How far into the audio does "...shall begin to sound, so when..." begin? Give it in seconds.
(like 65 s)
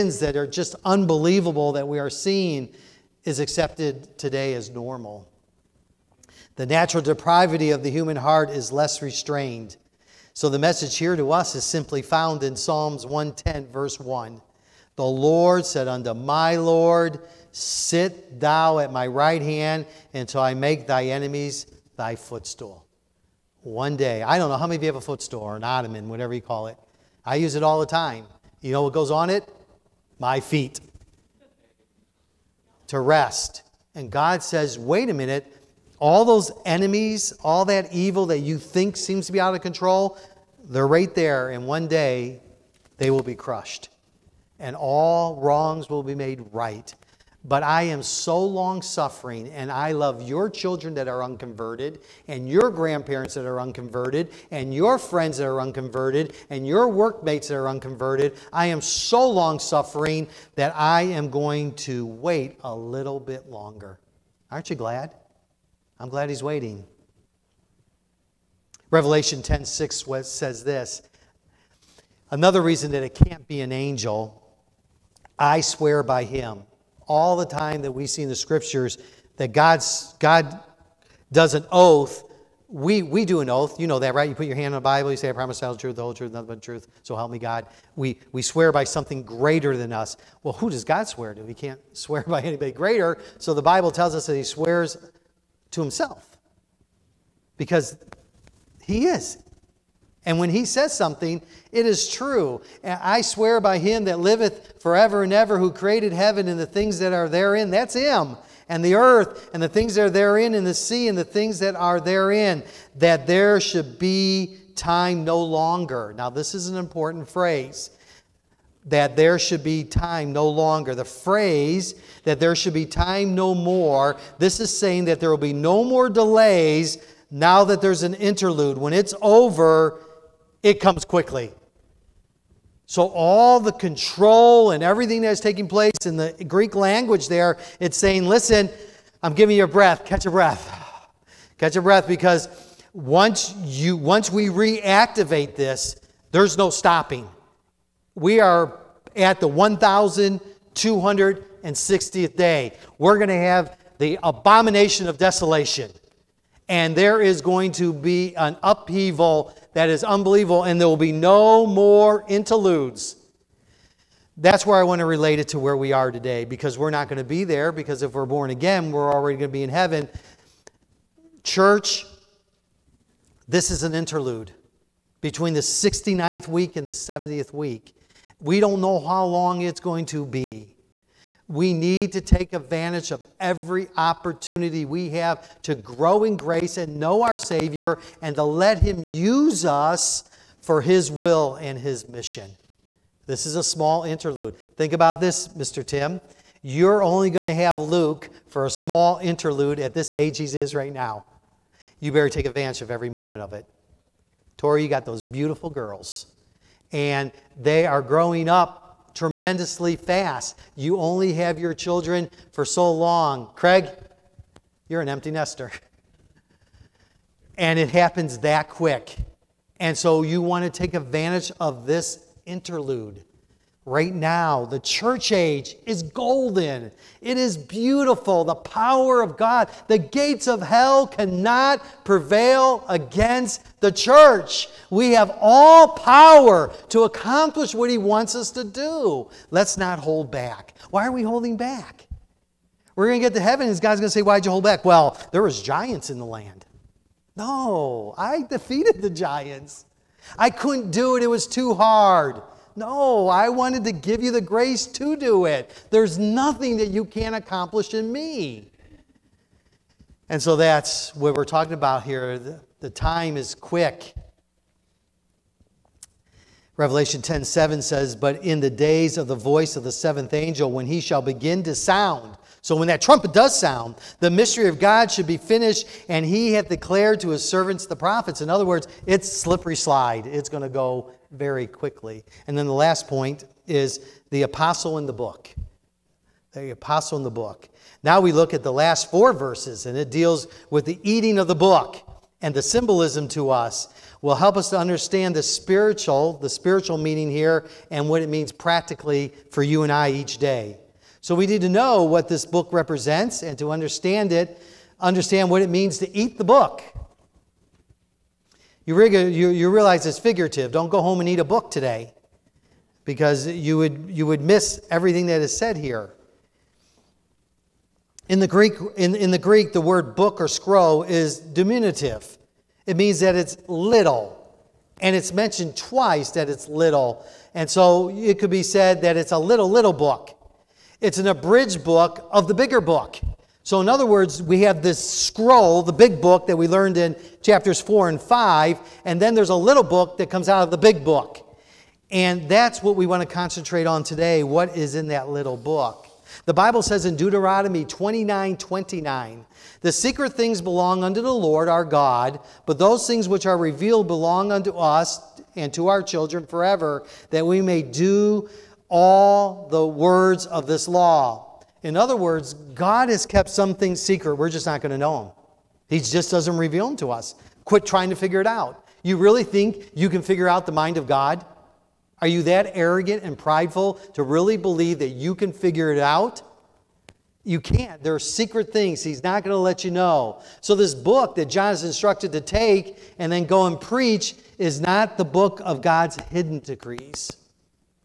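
270 s.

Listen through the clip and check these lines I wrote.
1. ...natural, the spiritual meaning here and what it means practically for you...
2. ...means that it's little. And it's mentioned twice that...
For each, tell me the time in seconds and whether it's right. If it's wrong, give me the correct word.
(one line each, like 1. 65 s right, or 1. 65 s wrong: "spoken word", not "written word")
1. 295 s wrong: "spiritual", not "natural"
2. 322 s right.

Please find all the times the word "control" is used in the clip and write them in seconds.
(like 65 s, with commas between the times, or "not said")
39 s, 133 s.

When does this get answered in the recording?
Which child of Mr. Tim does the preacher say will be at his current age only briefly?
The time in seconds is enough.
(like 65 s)
197 s.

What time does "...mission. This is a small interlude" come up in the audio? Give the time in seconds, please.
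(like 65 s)
192 s.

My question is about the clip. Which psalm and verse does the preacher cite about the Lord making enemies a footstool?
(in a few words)
Psalms 110:1.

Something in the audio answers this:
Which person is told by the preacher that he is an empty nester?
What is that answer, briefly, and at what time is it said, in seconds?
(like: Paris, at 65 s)
Craig, at 213 s.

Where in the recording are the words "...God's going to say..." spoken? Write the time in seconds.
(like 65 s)
243 s.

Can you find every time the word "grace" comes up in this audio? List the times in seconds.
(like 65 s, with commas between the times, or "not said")
186 s, 254 s.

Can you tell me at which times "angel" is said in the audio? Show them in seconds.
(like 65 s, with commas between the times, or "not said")
73 s, 270 s.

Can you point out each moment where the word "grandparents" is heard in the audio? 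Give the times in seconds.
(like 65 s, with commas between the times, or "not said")
52 s.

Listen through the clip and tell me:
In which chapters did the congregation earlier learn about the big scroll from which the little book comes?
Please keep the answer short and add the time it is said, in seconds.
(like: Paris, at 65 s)
chapters 4 and 5, at 337 s.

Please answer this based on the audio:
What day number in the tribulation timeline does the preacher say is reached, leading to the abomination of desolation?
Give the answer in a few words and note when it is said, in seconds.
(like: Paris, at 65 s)
1,260th, at 149 s.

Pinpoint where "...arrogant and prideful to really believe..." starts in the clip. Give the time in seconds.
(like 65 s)
372 s.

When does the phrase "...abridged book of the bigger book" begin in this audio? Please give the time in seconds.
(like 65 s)
331 s.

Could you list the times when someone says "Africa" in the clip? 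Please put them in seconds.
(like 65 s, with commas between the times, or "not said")
not said.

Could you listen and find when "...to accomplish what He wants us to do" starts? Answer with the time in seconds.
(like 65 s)
236 s.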